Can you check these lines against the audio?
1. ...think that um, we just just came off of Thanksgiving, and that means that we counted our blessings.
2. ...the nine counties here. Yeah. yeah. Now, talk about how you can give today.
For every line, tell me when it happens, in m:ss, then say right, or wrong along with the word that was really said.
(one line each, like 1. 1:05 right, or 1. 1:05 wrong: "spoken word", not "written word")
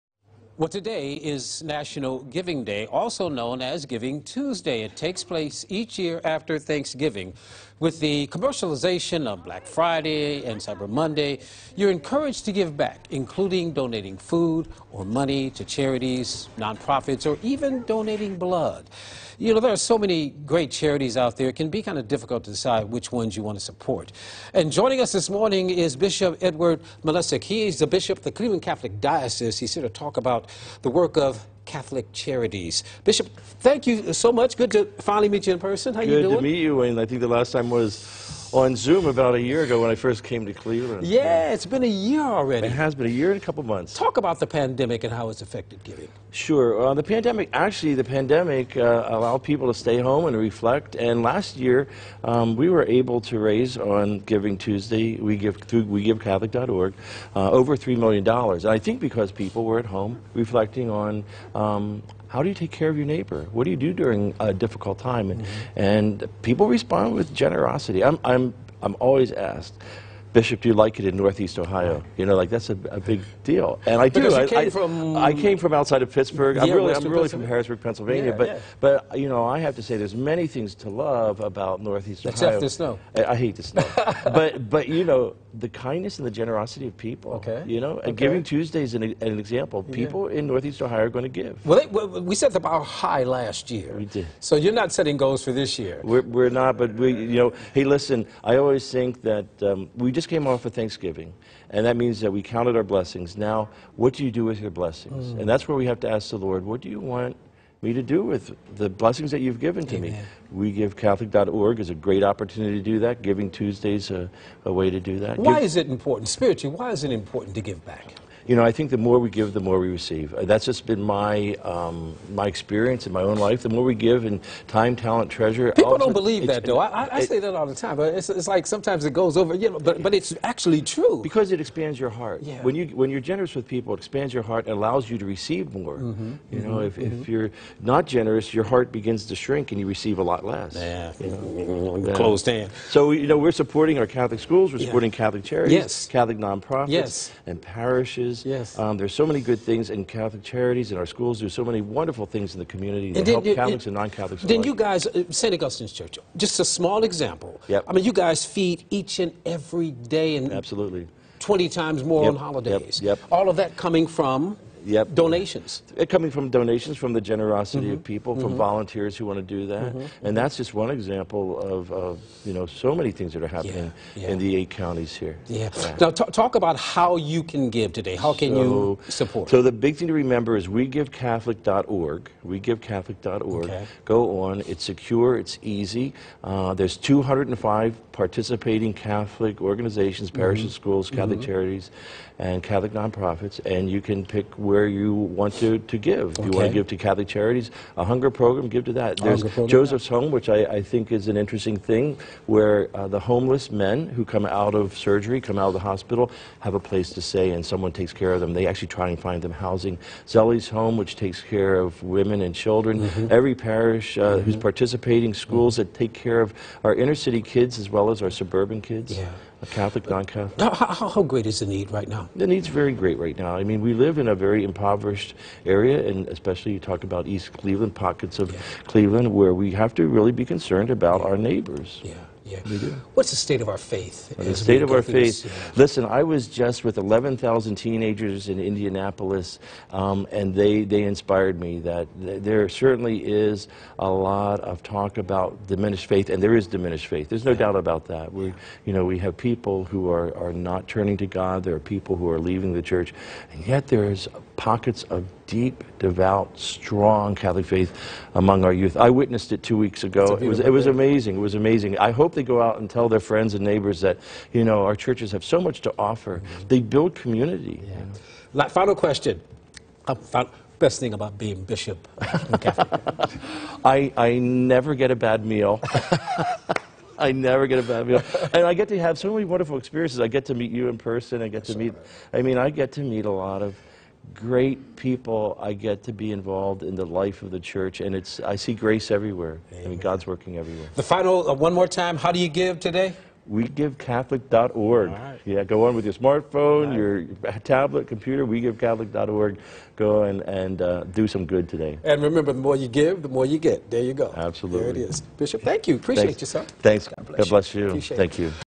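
1. 1:38 right
2. 2:54 wrong: "eight", not "nine".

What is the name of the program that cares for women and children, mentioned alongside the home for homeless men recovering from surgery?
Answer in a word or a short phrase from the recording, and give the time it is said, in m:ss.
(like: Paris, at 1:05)
Zelie's Home, at 3:30.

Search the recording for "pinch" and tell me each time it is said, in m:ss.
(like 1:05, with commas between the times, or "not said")
not said.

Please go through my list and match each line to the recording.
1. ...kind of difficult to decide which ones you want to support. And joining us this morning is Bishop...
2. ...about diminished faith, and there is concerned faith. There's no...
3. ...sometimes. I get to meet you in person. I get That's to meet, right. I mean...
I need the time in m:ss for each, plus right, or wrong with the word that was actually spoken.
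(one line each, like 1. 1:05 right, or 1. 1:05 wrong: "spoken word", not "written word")
1. 0:21 right
2. 4:05 wrong: "diminished", not "concerned"
3. 4:39 wrong: "experiences", not "sometimes".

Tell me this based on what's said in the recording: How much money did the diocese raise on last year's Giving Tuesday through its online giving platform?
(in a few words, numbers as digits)
Over $3 million.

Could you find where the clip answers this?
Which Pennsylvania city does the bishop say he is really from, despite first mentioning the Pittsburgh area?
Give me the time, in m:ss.
1:17.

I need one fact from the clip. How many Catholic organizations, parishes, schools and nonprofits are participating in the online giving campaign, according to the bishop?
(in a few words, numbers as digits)
205.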